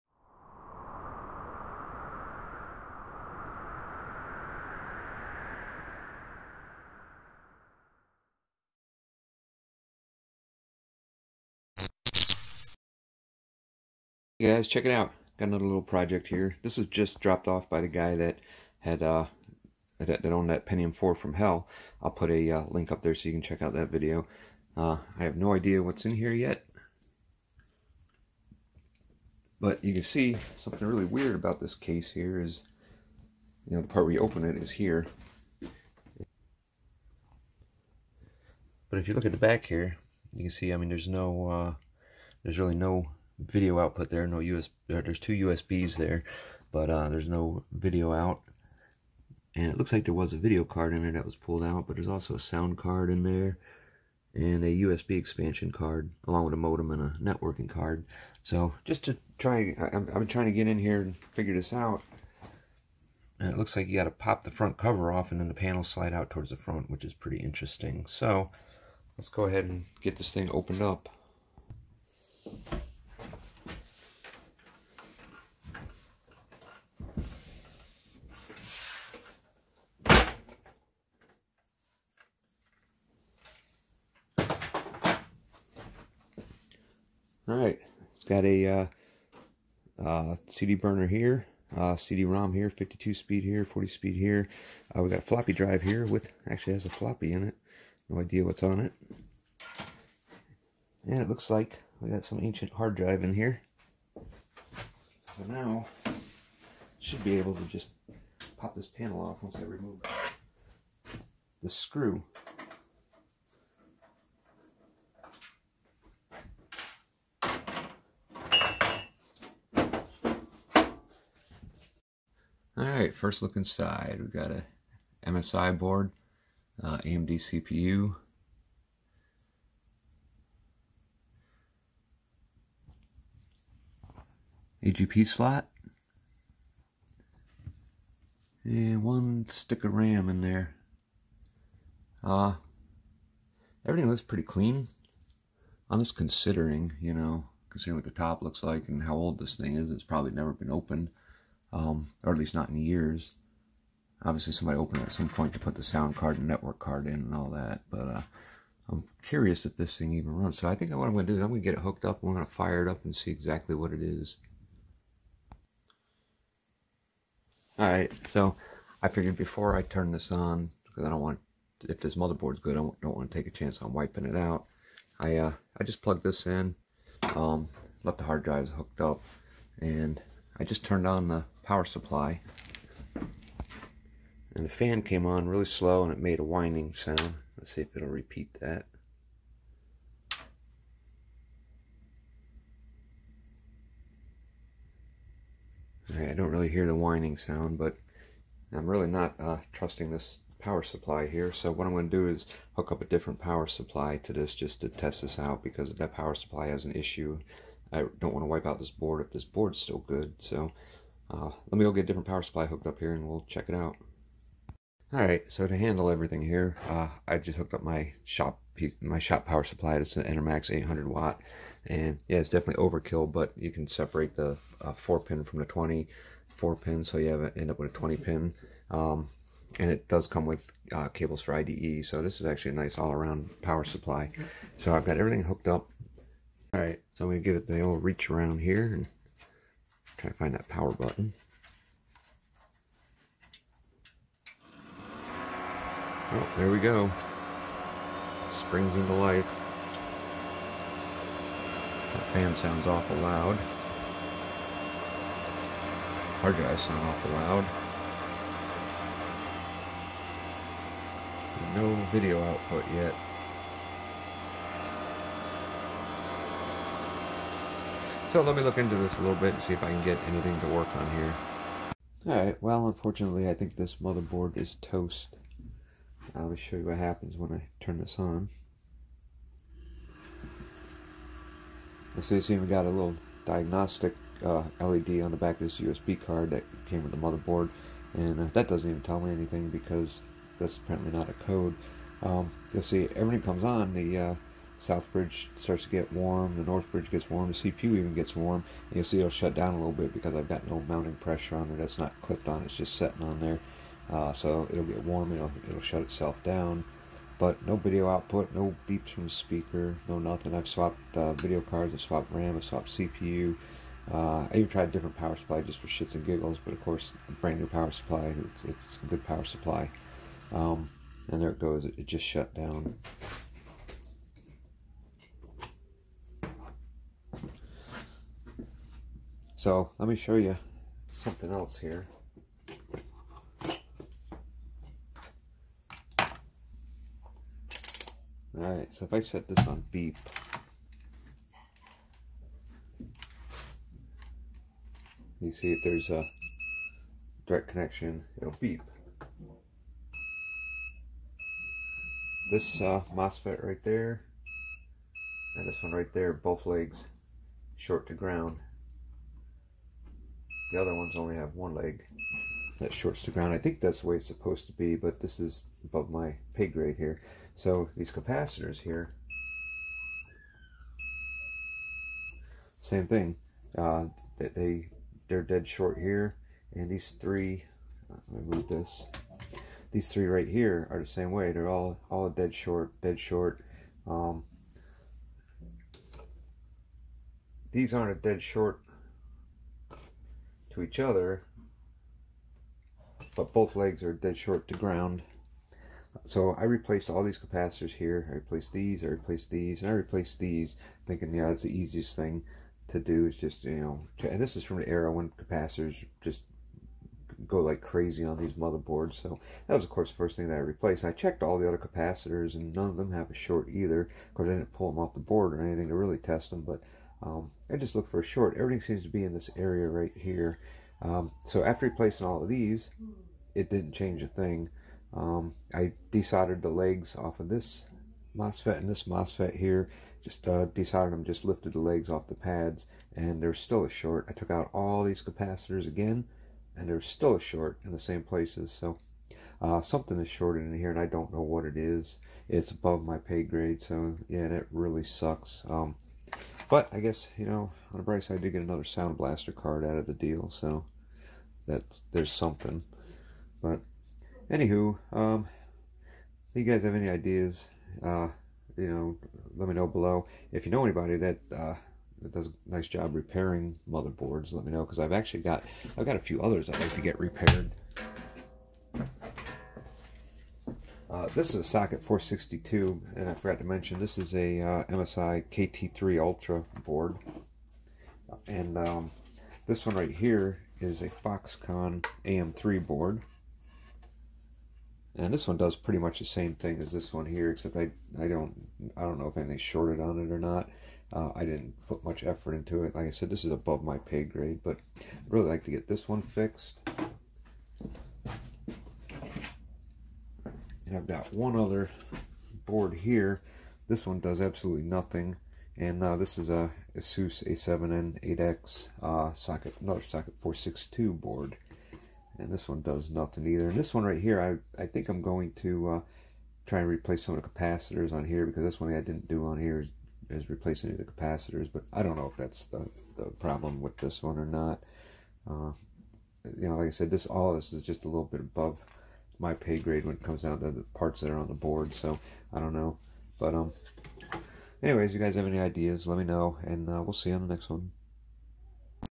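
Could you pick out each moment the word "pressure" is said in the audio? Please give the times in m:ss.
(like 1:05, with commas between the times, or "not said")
5:01.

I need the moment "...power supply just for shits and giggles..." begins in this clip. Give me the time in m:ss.
5:15.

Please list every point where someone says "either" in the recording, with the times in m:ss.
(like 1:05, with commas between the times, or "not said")
6:53, 8:33.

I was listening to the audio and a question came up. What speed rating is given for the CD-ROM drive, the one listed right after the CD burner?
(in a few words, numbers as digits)
52 speed.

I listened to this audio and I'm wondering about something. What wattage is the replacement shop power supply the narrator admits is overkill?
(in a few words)
800 watt.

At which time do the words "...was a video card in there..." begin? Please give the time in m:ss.
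0:50.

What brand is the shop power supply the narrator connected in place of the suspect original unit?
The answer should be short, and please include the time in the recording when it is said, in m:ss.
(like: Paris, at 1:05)
Enermax, at 3:40.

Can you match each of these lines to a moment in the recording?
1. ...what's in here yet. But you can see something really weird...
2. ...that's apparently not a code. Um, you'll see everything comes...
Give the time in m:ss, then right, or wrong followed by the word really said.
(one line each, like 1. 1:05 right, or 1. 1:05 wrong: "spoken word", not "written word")
1. 0:25 right
2. 4:50 right.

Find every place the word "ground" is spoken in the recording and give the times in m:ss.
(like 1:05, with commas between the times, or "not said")
5:58, 6:03, 6:34.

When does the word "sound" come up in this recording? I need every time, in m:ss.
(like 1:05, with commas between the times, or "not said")
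0:52, 2:35, 3:06, 3:17, 4:12, 4:16, 7:28.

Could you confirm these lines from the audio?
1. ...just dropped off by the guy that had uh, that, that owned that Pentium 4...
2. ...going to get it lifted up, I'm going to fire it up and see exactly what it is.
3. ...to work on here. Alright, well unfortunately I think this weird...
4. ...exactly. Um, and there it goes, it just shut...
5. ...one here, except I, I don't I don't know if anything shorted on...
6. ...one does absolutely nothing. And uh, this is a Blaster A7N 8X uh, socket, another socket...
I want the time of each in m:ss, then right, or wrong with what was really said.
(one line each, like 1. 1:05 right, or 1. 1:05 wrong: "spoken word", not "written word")
1. 0:16 right
2. 2:41 wrong: "hooked", not "lifted"
3. 4:30 wrong: "motherboard", not "weird"
4. 5:19 wrong: "supply", not "exactly"
5. 8:07 right
6. 8:24 wrong: "ASUS", not "Blaster".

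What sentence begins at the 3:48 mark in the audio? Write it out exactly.
Um, and it does come with uh, cables for IDE, so this is actually a nice all-around power supply.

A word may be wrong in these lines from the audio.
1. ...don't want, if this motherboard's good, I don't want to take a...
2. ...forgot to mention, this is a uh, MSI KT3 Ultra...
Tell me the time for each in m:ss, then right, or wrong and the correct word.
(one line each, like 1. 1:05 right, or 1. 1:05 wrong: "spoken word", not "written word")
1. 2:51 right
2. 7:53 right.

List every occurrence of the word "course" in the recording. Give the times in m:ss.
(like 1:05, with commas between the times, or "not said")
5:16, 6:49, 6:54.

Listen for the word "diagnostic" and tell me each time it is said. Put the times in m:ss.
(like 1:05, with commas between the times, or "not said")
4:43.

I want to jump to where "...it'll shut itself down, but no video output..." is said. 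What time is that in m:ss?
5:05.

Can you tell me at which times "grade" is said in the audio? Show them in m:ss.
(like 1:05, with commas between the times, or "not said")
6:06, 7:23, 8:14, 8:49.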